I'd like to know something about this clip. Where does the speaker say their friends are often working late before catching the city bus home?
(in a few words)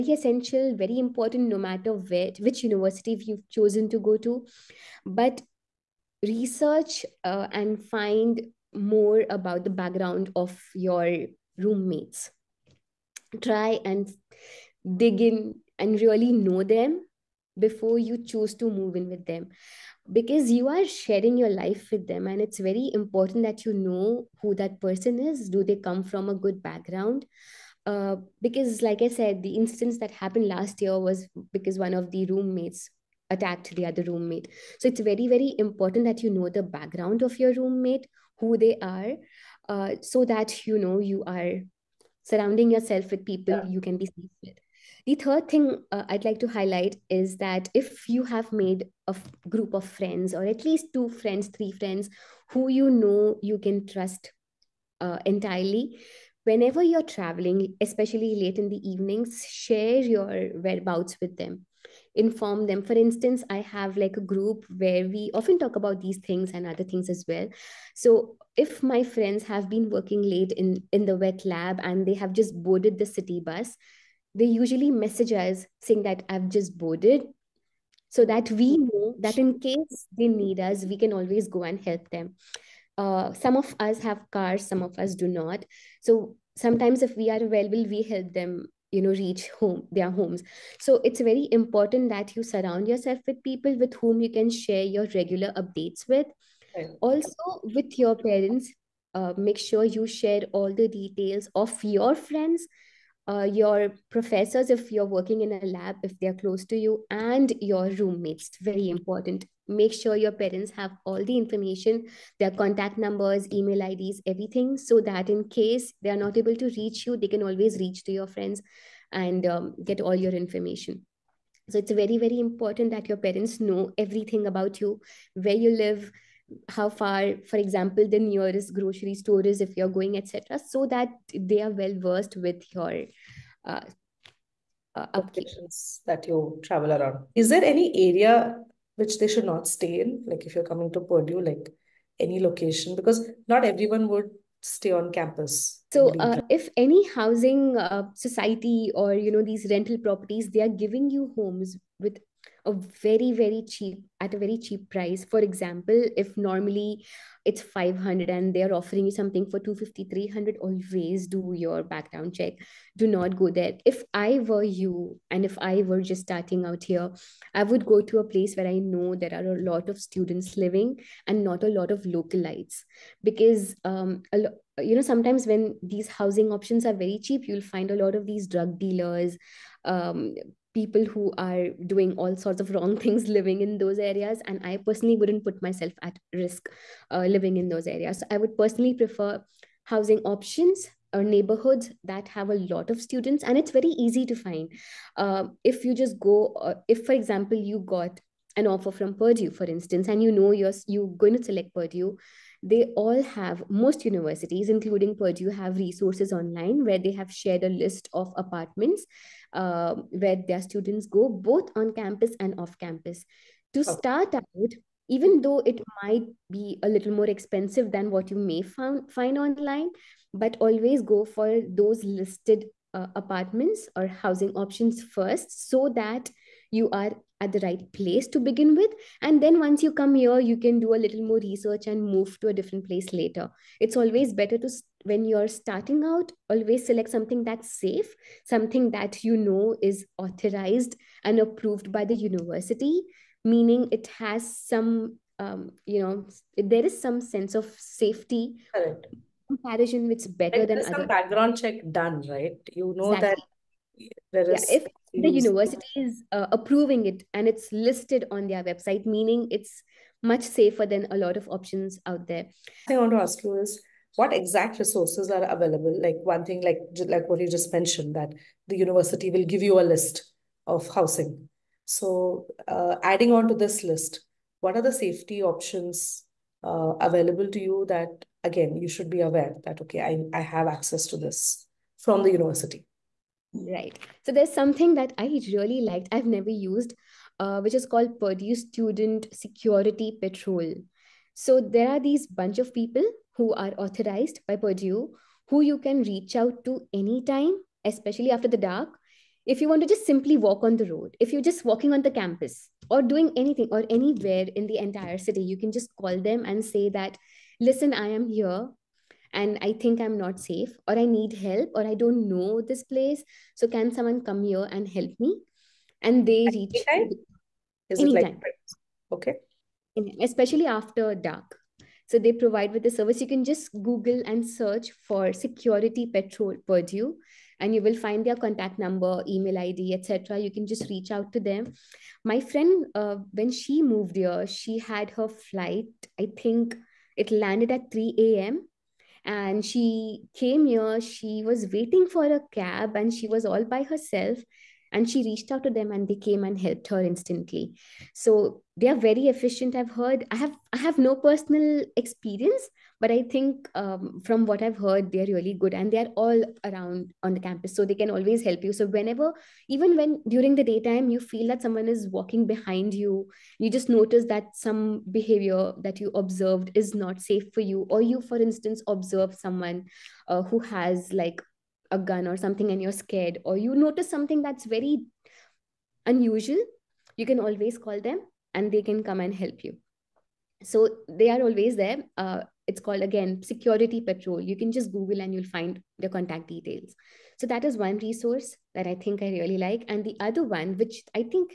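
wet lab.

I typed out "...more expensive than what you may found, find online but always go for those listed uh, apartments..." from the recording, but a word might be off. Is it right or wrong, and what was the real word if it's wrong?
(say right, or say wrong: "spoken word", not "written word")
right.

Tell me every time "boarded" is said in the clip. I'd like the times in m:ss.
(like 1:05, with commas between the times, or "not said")
1:12, 1:16.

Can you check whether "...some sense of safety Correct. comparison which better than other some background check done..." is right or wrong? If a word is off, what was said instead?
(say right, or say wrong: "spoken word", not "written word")
right.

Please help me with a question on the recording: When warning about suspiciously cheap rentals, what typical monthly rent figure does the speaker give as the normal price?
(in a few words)
500.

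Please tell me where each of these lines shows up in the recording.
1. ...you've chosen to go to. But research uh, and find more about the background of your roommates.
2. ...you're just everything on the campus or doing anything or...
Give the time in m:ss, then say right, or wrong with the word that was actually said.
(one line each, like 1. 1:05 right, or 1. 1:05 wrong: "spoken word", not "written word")
1. 0:03 right
2. 5:01 wrong: "walking", not "everything".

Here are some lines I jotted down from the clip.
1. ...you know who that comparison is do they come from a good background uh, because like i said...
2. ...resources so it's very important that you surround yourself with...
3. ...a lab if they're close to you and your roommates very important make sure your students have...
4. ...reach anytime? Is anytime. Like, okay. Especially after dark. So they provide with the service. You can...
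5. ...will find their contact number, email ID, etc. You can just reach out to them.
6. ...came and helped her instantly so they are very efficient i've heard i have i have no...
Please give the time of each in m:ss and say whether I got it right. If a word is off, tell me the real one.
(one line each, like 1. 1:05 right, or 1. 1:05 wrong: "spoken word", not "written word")
1. 0:23 wrong: "person", not "comparison"
2. 1:30 wrong: "homes", not "resources"
3. 1:45 wrong: "parents", not "students"
4. 5:16 right
5. 5:27 right
6. 5:46 right.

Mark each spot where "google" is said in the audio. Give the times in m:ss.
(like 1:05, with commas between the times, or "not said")
5:23, 6:24.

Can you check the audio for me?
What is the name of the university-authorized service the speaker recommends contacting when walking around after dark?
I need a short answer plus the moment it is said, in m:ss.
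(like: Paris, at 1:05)
Purdue Student Security Patrol, at 4:48.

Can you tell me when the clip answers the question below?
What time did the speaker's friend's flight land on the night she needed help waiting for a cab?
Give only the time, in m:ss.
5:37.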